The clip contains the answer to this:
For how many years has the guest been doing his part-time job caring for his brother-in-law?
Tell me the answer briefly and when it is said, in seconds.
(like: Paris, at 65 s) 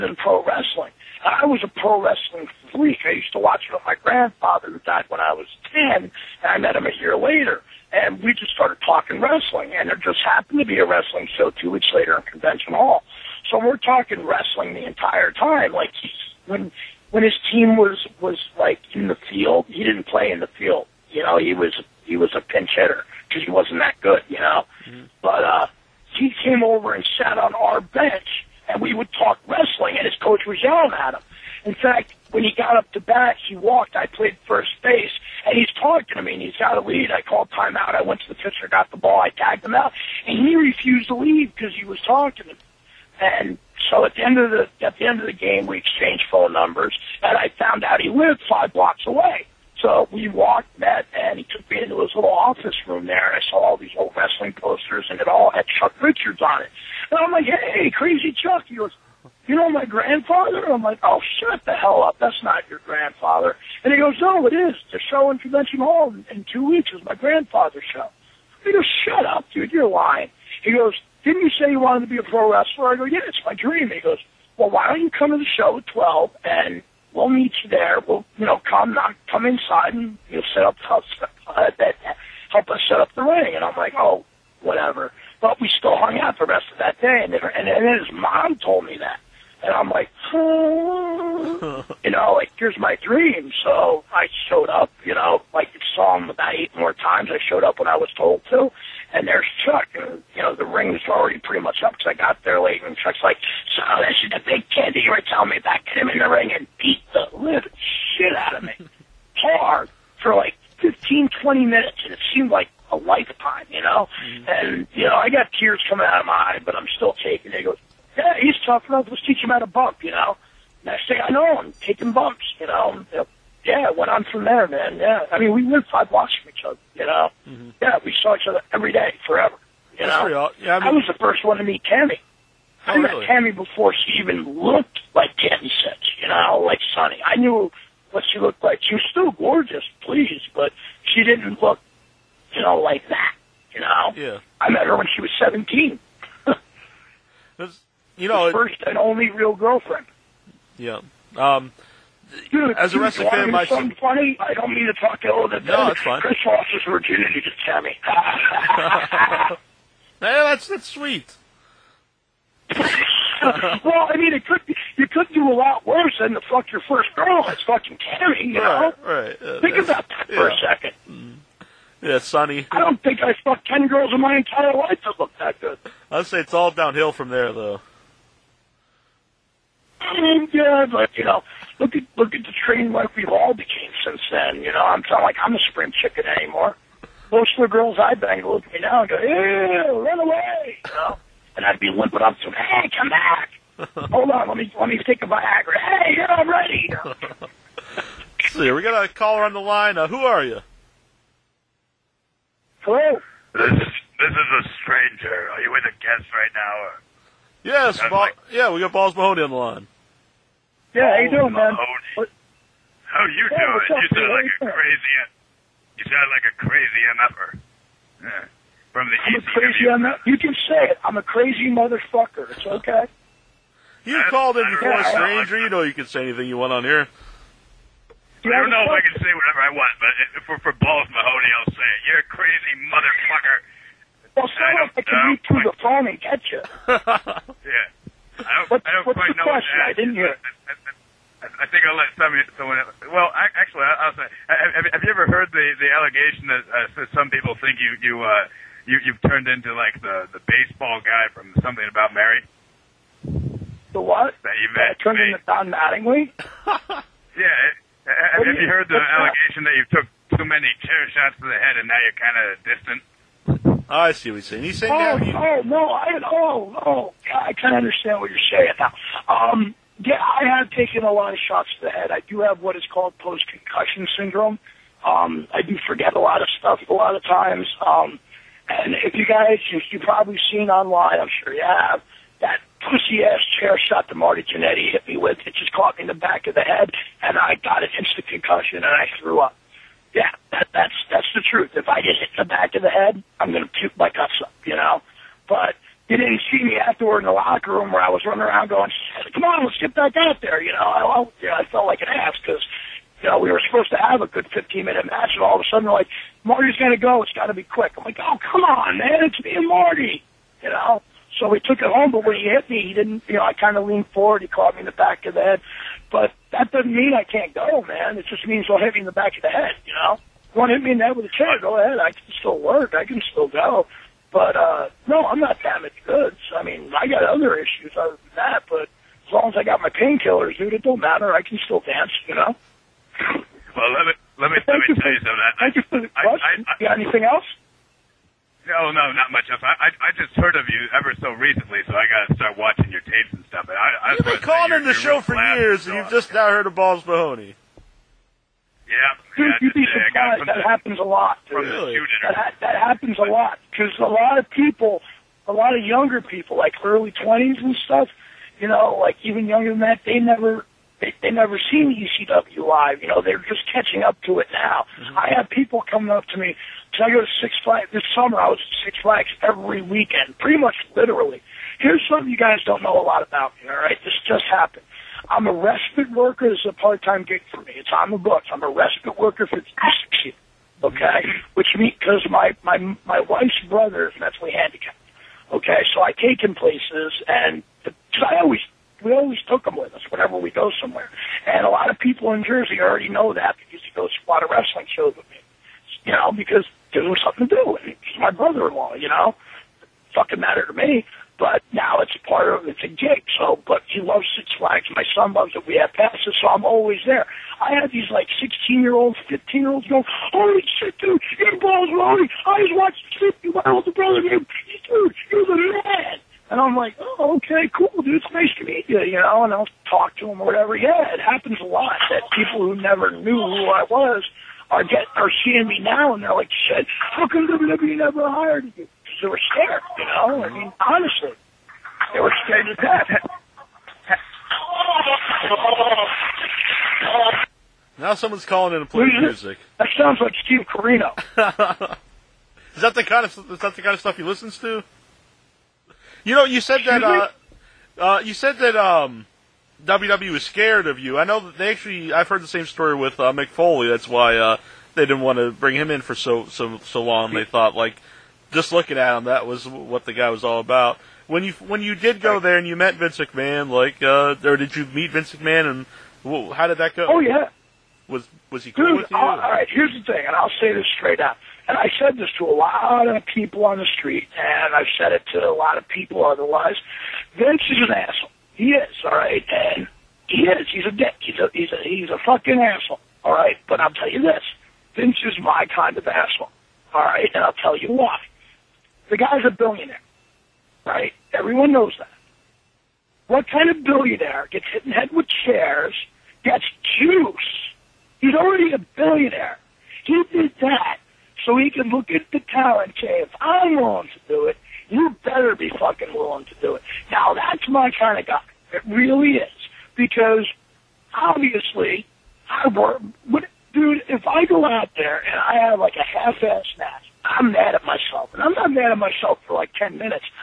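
6, at 379 s.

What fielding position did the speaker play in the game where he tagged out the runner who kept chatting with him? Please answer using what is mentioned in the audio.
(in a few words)
First base.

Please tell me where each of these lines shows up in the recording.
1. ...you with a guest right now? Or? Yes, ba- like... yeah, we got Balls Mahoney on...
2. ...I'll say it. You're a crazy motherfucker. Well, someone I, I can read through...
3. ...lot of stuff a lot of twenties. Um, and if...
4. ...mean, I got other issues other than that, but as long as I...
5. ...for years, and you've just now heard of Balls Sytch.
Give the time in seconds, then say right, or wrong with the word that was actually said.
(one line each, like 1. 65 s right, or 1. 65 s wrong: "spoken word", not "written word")
1. 205 s right
2. 231 s right
3. 276 s wrong: "times", not "twenties"
4. 326 s right
5. 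345 s wrong: "Mahoney", not "Sytch".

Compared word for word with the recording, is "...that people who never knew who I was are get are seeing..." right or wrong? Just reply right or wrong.
right.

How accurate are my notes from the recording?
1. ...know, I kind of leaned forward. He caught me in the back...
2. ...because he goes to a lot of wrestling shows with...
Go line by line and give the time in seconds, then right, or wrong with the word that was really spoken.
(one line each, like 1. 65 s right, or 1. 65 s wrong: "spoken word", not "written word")
1. 313 s right
2. 393 s right.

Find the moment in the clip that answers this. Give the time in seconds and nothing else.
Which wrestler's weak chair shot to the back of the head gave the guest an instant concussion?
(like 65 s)
284 s.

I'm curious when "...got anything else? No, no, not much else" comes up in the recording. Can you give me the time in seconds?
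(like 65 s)
336 s.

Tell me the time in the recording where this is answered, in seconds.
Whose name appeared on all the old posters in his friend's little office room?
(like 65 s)
55 s.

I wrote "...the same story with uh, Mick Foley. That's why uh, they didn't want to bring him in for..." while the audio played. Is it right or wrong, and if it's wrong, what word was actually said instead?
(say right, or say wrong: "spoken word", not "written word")
right.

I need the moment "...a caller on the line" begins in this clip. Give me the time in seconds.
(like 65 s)
199 s.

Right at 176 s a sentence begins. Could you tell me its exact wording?
I'd say it's all downhill from there, though.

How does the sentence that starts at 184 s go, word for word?
You know, I'm not like I'm a spring chicken anymore.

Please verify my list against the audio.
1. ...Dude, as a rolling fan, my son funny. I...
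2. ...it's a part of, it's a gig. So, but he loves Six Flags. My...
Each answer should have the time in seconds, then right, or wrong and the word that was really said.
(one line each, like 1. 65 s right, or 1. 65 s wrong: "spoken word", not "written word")
1. 152 s wrong: "wrestling", not "rolling"
2. 401 s right.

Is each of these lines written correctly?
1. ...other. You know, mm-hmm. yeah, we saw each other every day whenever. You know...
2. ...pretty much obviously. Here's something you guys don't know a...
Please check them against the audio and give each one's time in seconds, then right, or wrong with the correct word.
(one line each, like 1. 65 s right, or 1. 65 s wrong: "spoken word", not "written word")
1. 126 s wrong: "forever", not "whenever"
2. 370 s wrong: "literally", not "obviously".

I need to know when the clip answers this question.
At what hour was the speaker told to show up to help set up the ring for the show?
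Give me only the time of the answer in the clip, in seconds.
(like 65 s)
75 s.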